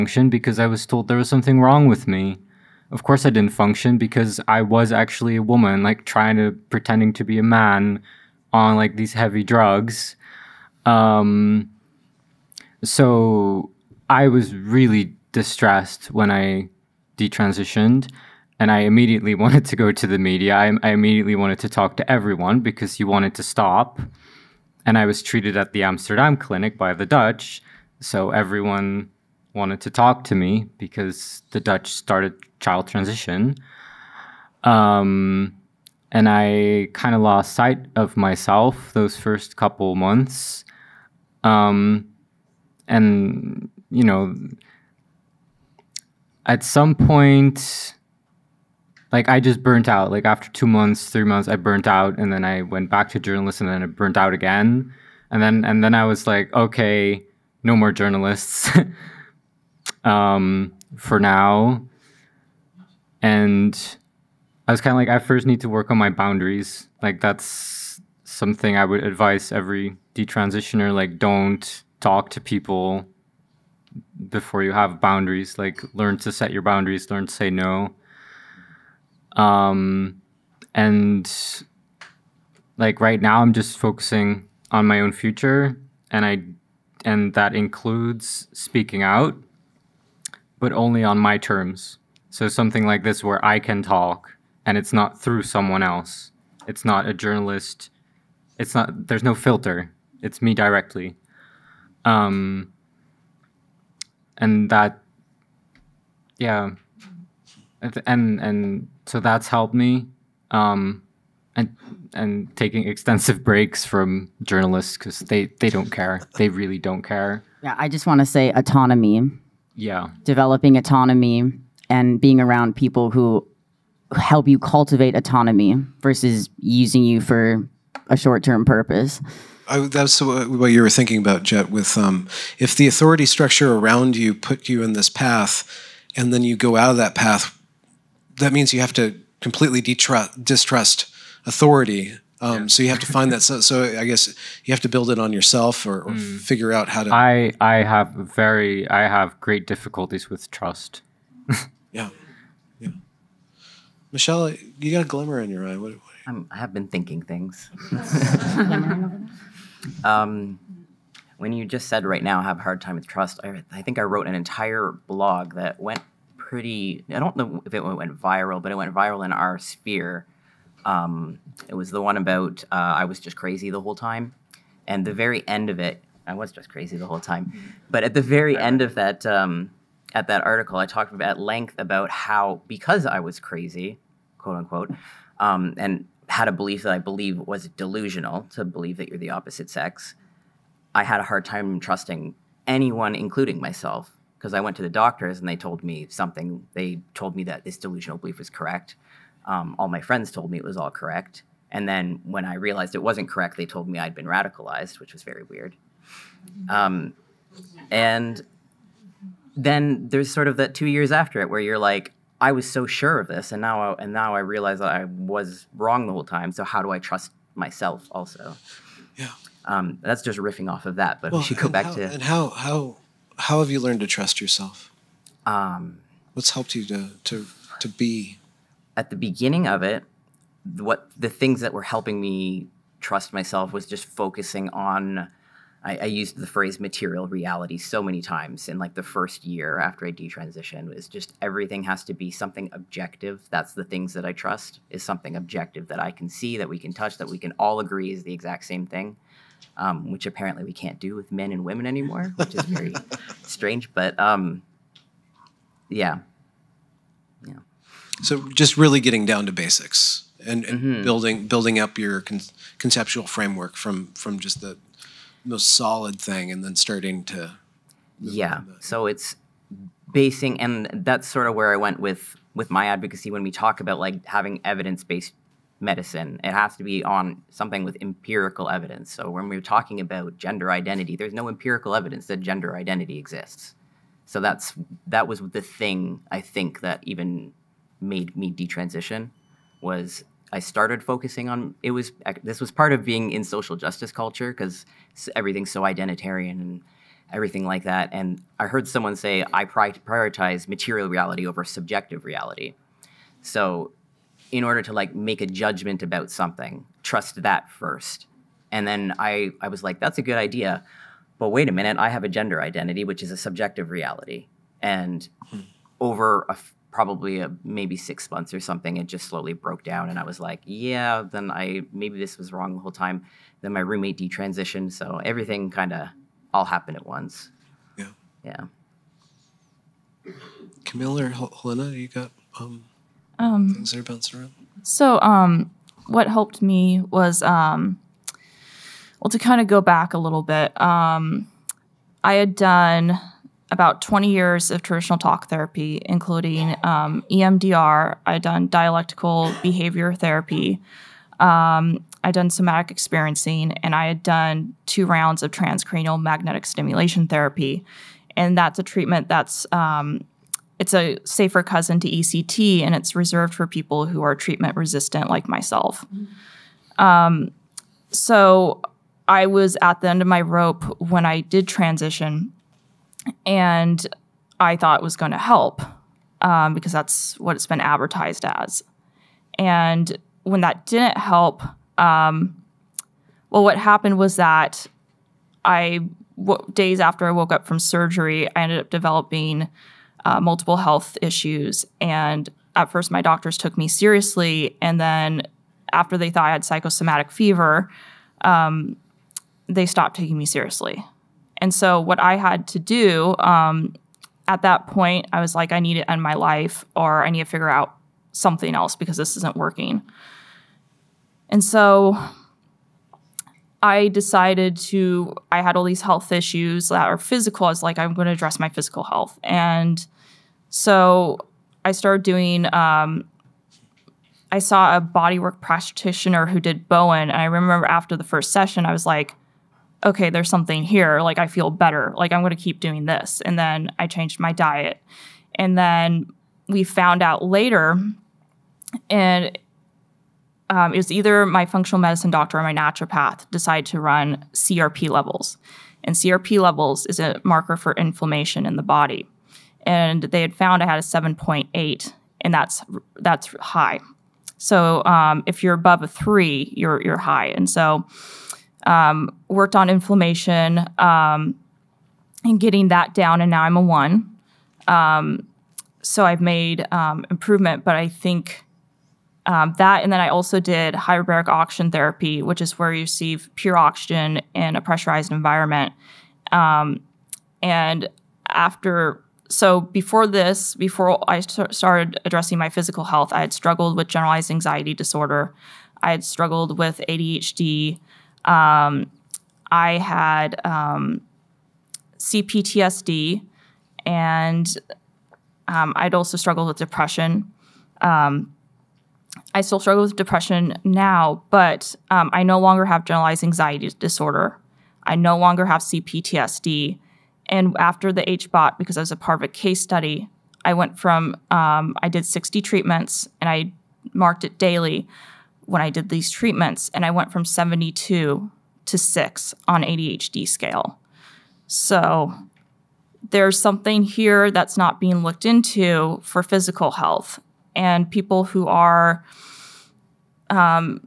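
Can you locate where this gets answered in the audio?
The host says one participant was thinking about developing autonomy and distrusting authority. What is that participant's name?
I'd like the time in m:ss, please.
2:11.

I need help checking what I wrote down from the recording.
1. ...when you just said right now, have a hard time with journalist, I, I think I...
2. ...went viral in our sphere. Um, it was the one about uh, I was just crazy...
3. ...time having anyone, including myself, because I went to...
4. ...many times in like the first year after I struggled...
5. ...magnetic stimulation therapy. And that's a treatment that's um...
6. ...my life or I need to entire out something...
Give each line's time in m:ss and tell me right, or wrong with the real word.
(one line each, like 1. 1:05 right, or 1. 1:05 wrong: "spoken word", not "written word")
1. 2:41 wrong: "trust", not "journalist"
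2. 2:48 right
3. 3:11 wrong: "trusting", not "having"
4. 3:58 wrong: "detransitioned", not "struggled"
5. 5:56 right
6. 6:46 wrong: "figure", not "entire".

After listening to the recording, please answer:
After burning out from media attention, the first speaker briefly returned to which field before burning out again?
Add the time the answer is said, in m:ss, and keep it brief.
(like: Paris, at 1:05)
journalism, at 0:53.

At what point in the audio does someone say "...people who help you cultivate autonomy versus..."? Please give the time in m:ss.
2:02.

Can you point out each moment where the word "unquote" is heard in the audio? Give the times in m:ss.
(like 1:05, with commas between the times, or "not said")
3:04.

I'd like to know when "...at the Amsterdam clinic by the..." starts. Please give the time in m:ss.
0:25.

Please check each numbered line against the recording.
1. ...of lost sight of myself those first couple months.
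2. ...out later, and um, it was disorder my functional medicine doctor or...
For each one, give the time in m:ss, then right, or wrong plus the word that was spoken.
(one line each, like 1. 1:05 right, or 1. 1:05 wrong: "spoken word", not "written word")
1. 0:37 right
2. 7:17 wrong: "either", not "disorder".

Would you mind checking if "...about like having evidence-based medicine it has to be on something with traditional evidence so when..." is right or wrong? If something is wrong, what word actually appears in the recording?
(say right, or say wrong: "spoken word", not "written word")
wrong: "empirical", not "traditional".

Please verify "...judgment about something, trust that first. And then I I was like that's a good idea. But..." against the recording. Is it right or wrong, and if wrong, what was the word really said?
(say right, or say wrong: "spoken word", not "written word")
right.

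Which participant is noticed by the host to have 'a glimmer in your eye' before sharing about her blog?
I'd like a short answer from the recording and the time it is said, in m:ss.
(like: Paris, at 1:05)
Michelle, at 2:34.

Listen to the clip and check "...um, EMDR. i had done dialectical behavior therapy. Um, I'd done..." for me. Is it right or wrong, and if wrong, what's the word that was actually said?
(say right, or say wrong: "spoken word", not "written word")
right.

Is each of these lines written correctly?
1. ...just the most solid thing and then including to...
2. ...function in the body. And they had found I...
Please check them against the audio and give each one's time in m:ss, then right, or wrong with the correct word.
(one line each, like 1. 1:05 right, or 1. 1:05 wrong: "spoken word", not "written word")
1. 4:24 wrong: "starting", not "including"
2. 7:27 wrong: "inflammation", not "function".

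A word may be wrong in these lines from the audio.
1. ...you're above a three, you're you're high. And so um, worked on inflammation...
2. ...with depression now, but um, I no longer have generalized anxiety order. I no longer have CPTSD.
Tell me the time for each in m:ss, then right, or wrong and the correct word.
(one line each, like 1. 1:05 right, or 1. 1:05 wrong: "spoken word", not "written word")
1. 7:35 right
2. 8:20 wrong: "disorder", not "order".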